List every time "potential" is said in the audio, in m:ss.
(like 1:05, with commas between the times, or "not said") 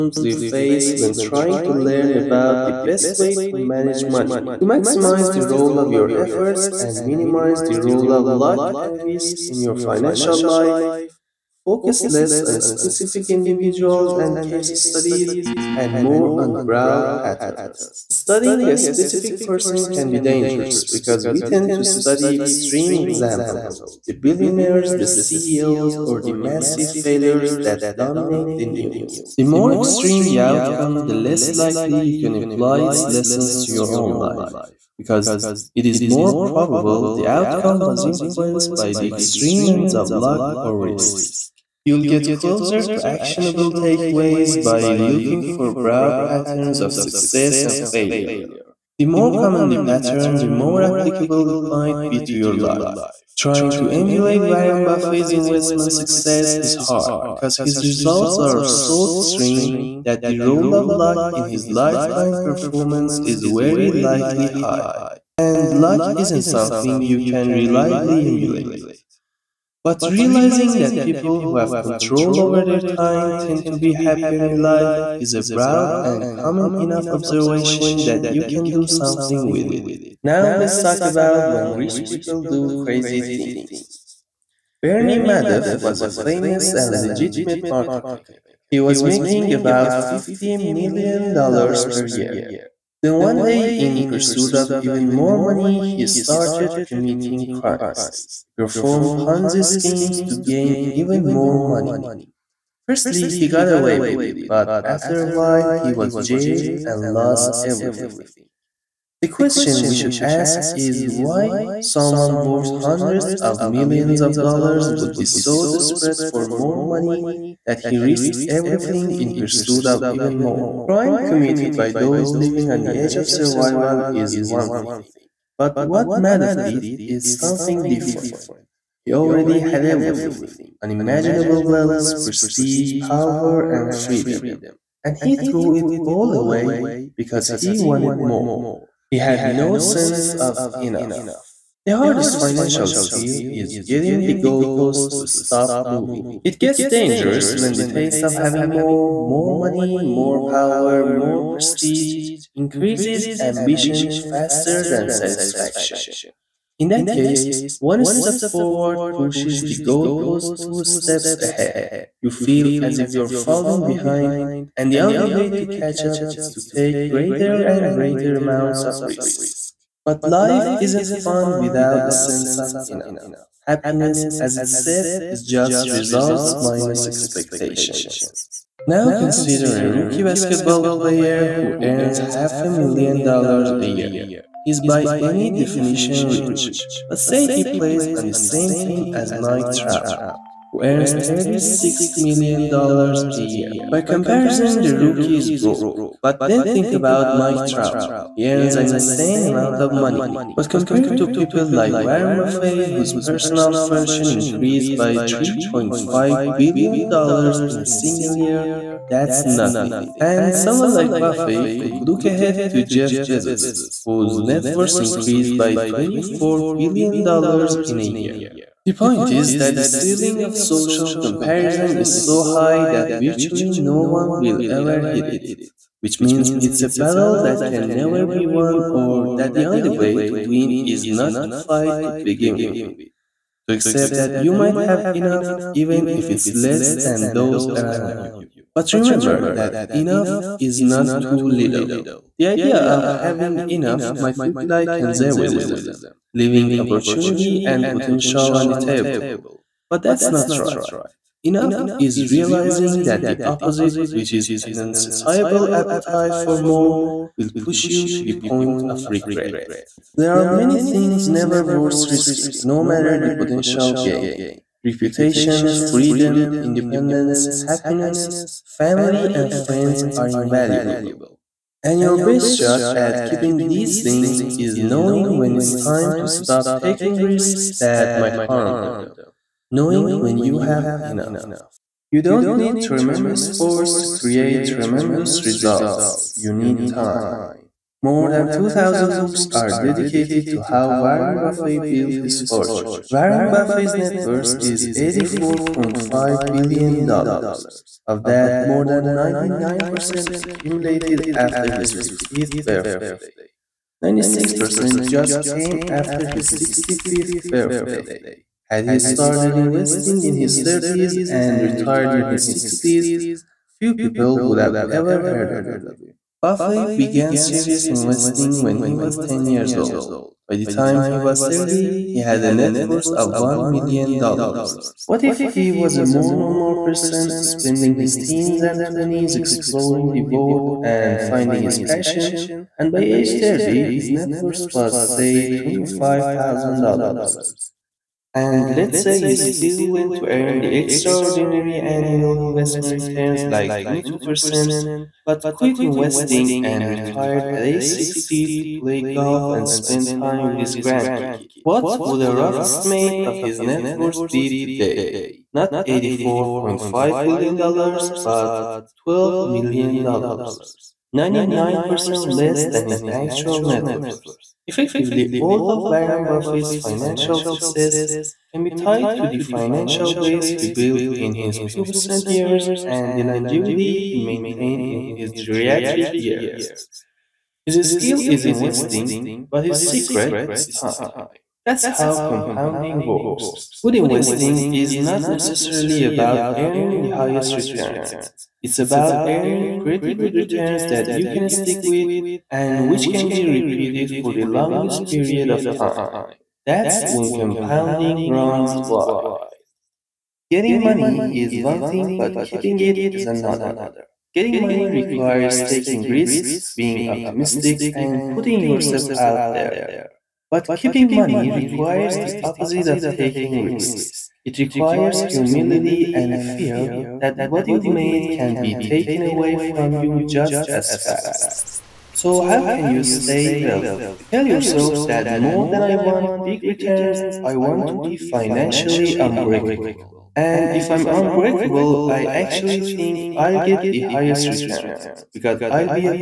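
4:07, 4:23.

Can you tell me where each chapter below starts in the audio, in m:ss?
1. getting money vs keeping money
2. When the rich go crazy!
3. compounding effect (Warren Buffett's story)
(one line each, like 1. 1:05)
1. 6:38
2. 1:20
3. 4:41.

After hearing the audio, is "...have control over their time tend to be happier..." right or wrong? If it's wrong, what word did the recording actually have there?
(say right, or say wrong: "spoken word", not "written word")
right.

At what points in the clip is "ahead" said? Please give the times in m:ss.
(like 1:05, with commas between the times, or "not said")
2:41, 3:32.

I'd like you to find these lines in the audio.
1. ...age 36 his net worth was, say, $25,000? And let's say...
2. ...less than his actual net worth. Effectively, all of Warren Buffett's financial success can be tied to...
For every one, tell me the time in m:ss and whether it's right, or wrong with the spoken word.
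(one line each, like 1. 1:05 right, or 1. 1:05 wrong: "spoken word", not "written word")
1. 5:32 wrong: "30", not "36"
2. 6:02 right.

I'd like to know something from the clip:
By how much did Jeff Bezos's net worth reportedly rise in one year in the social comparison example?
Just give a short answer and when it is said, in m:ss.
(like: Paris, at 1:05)
$24 billion, at 3:35.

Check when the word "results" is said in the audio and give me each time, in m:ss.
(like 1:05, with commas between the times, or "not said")
0:57, 2:55, 4:45.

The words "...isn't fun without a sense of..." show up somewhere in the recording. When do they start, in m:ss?
2:50.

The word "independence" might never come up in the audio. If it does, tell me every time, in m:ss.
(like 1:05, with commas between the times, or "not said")
4:26.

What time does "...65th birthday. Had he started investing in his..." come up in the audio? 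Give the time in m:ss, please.
5:06.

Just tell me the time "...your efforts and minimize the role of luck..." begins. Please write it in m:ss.
0:05.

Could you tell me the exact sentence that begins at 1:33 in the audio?
Then one day, in pursuit of even more money, he started committing crimes.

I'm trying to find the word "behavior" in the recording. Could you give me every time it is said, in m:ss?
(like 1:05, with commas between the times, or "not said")
not said.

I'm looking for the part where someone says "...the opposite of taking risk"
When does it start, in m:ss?
6:52.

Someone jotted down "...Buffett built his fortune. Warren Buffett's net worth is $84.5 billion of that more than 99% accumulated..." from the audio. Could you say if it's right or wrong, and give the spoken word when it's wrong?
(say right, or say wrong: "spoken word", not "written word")
right.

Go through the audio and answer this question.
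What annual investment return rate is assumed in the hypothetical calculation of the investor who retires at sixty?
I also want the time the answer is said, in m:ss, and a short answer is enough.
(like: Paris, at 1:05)
22%, at 5:43.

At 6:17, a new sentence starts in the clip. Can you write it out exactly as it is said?
His skill is investing, but his secret is time.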